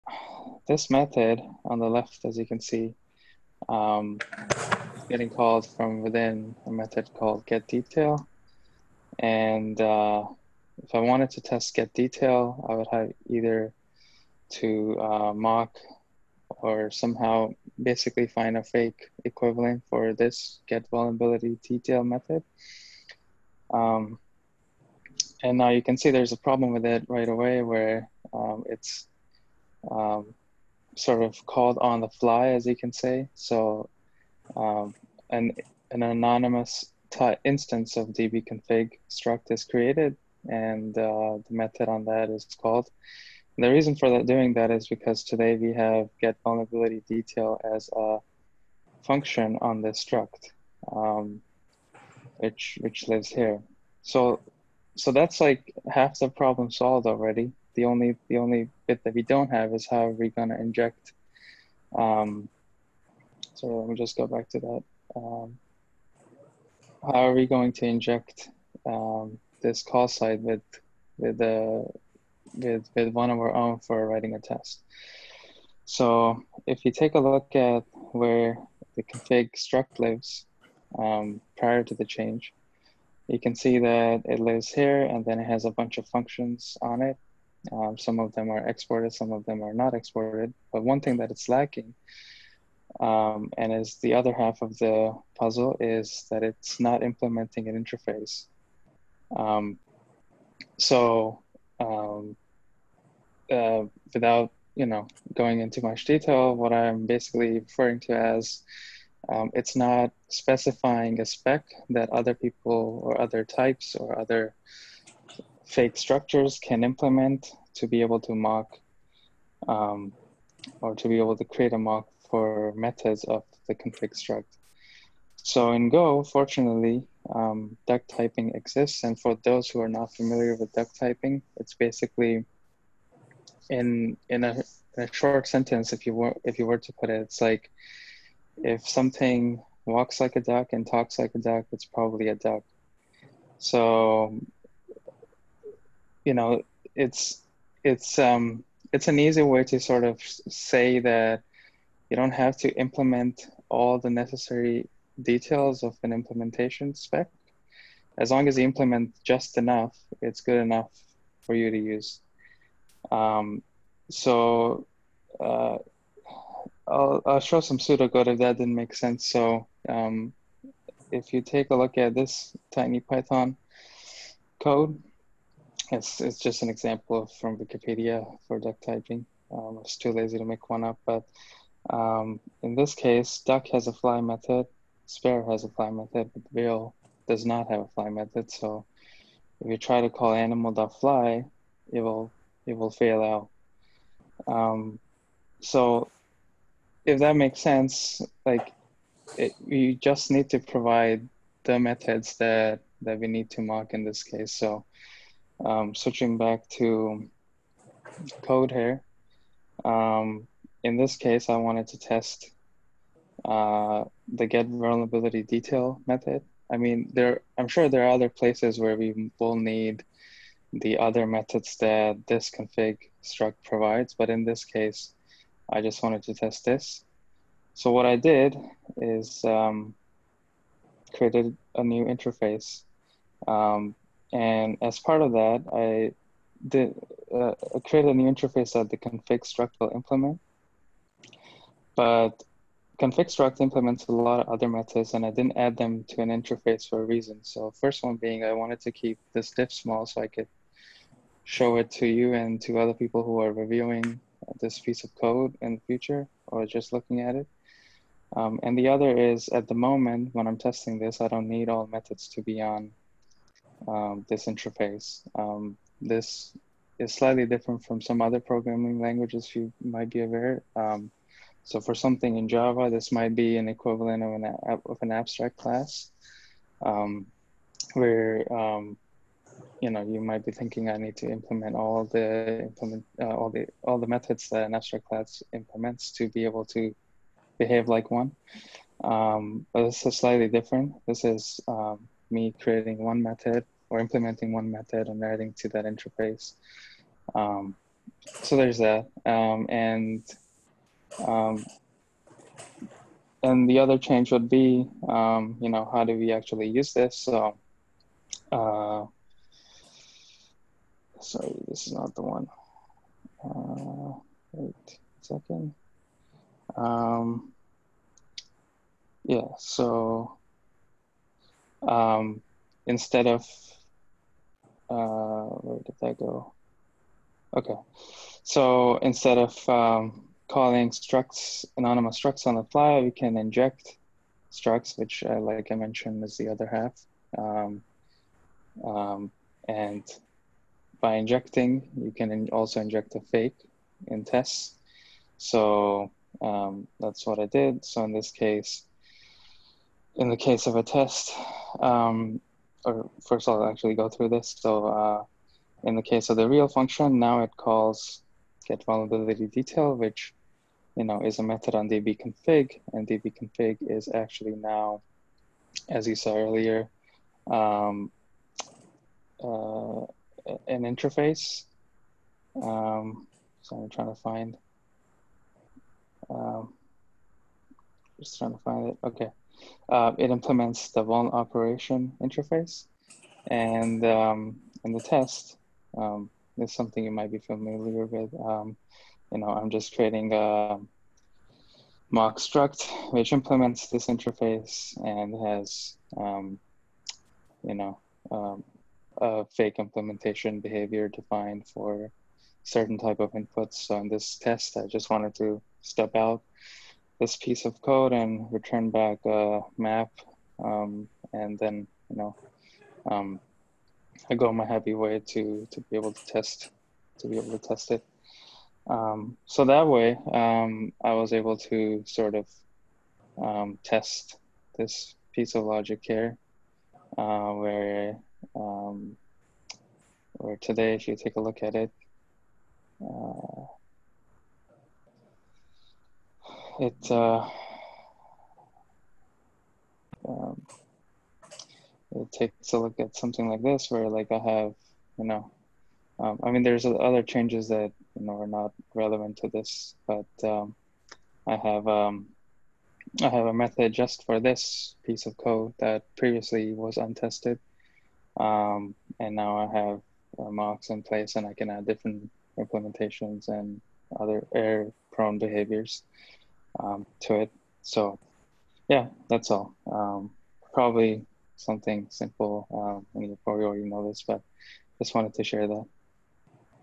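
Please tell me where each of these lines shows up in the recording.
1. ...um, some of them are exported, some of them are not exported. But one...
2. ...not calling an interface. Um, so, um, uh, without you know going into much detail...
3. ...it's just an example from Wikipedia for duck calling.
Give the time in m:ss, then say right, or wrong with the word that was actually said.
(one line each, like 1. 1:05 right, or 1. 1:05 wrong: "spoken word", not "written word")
1. 1:27 right
2. 1:36 wrong: "implementing", not "calling"
3. 2:56 wrong: "typing", not "calling".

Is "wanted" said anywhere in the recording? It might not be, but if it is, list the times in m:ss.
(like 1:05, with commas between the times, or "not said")
0:10, 3:31, 3:46, 4:08, 6:45, 7:55.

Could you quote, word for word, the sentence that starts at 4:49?
Um, but this is slightly different.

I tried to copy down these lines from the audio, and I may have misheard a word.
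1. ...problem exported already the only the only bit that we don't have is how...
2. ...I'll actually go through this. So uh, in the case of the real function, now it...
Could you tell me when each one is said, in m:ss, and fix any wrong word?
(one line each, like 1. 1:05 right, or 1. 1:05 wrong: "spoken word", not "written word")
1. 0:56 wrong: "solved", not "exported"
2. 5:53 right.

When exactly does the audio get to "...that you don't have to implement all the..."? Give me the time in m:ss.
2:30.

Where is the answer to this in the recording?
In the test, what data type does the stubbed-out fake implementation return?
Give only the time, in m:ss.
6:49.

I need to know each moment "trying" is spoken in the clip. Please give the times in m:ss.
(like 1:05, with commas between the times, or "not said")
6:13, 6:18.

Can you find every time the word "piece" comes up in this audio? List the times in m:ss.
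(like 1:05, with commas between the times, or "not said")
4:14, 6:47, 7:05, 7:35.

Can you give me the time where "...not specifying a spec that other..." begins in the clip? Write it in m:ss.
1:49.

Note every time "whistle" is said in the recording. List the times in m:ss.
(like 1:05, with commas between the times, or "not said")
not said.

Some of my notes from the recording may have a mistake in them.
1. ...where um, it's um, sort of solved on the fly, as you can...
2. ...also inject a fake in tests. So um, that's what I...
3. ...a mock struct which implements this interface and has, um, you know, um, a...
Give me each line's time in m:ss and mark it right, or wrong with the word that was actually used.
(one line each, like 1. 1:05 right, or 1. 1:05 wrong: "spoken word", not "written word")
1. 0:27 wrong: "called", not "solved"
2. 5:42 right
3. 6:30 right.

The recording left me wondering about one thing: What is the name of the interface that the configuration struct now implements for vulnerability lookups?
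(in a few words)
vuln operation.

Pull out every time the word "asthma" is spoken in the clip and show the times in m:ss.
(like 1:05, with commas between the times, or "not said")
not said.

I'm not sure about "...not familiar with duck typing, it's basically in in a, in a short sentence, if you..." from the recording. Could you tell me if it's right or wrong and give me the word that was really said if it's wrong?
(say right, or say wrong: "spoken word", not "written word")
right.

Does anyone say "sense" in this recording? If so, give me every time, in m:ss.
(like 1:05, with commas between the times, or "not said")
2:48, 3:17.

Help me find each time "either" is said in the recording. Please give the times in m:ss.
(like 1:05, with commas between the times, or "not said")
0:13.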